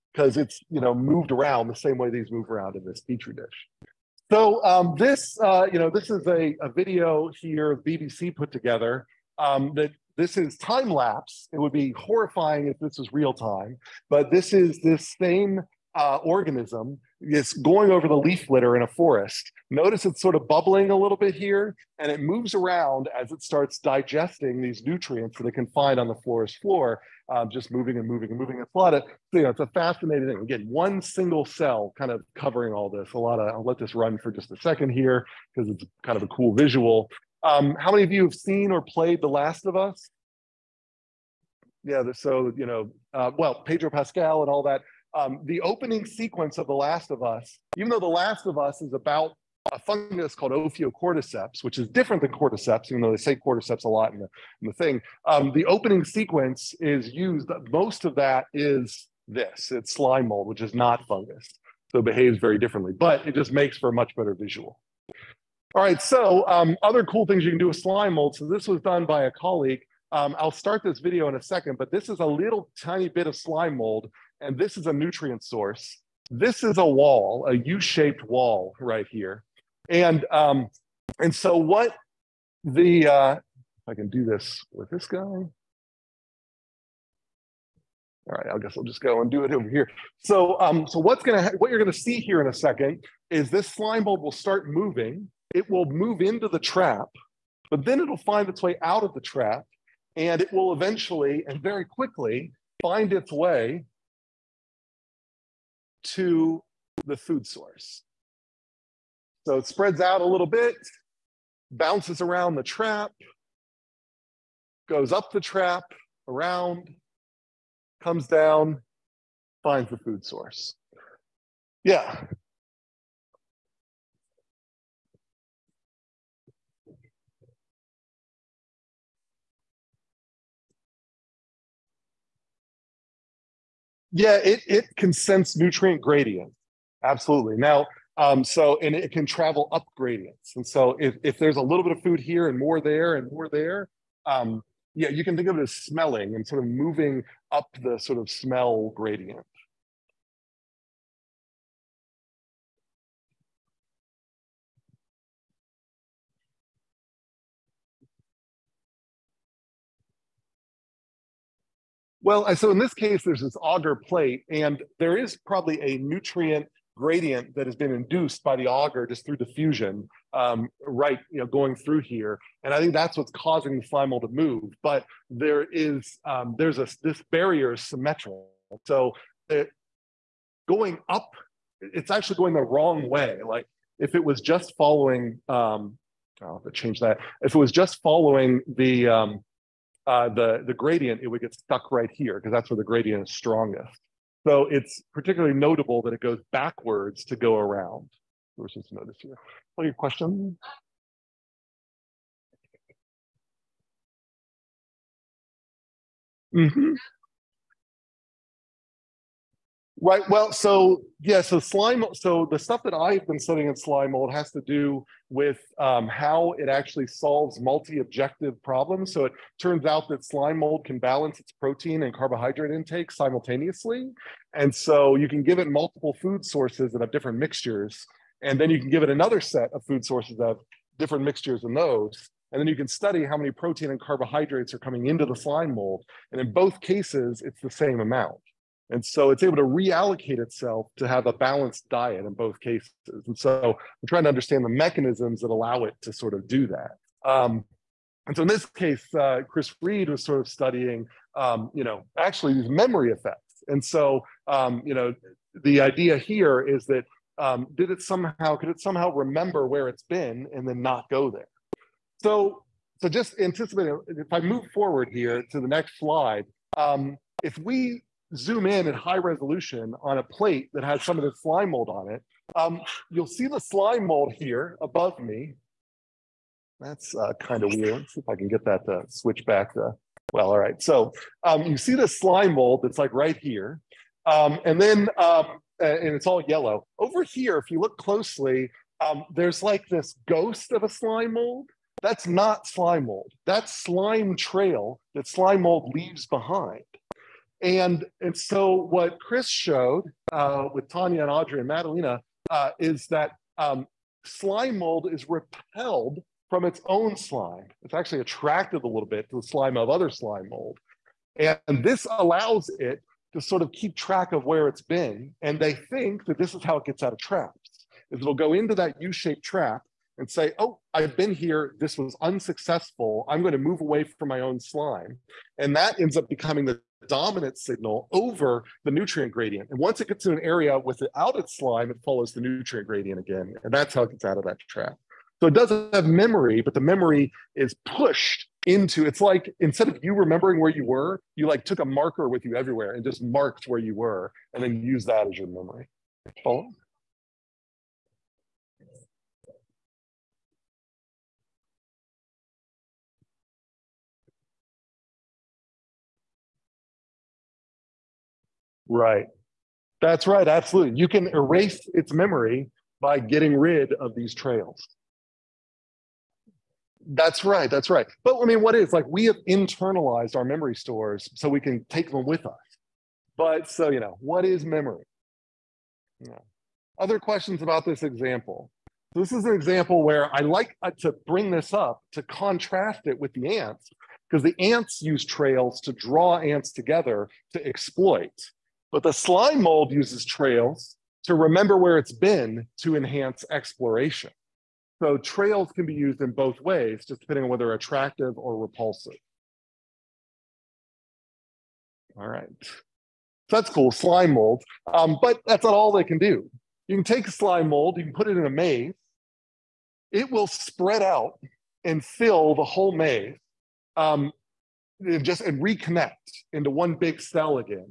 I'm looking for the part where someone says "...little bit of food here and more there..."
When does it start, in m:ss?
2:21.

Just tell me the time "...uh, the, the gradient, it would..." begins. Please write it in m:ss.
3:10.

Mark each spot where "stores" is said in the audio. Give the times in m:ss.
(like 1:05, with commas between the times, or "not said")
6:10.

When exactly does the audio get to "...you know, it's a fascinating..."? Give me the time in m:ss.
0:29.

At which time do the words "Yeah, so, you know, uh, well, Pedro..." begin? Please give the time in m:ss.
0:41.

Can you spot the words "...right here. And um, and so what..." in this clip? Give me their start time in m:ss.
1:18.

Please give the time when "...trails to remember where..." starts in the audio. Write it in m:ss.
6:30.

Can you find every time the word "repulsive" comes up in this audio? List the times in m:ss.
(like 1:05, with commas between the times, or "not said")
6:38.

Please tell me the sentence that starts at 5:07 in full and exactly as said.
It's actually attracted a little bit to the slime of other slime mold.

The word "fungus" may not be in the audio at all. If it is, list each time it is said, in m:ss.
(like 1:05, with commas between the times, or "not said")
0:49, 1:01.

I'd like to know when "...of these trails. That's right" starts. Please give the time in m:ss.
6:03.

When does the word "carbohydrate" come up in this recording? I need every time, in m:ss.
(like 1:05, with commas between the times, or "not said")
3:42, 3:54.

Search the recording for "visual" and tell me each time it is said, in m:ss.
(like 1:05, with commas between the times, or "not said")
0:36, 1:04.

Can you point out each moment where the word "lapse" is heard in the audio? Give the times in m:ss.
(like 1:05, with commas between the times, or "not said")
0:10.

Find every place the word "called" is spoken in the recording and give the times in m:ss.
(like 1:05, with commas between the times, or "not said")
0:50.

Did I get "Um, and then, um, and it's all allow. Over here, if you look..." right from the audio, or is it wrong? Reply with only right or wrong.
wrong.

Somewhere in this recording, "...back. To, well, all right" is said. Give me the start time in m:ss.
4:39.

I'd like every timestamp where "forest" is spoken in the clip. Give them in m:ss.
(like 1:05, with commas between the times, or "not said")
0:18, 0:26.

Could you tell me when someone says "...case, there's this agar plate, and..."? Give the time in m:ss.
2:42.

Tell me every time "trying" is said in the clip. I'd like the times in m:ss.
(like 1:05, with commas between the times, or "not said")
4:04.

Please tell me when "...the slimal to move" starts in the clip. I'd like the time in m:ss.
2:53.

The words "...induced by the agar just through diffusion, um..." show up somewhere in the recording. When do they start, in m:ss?
2:47.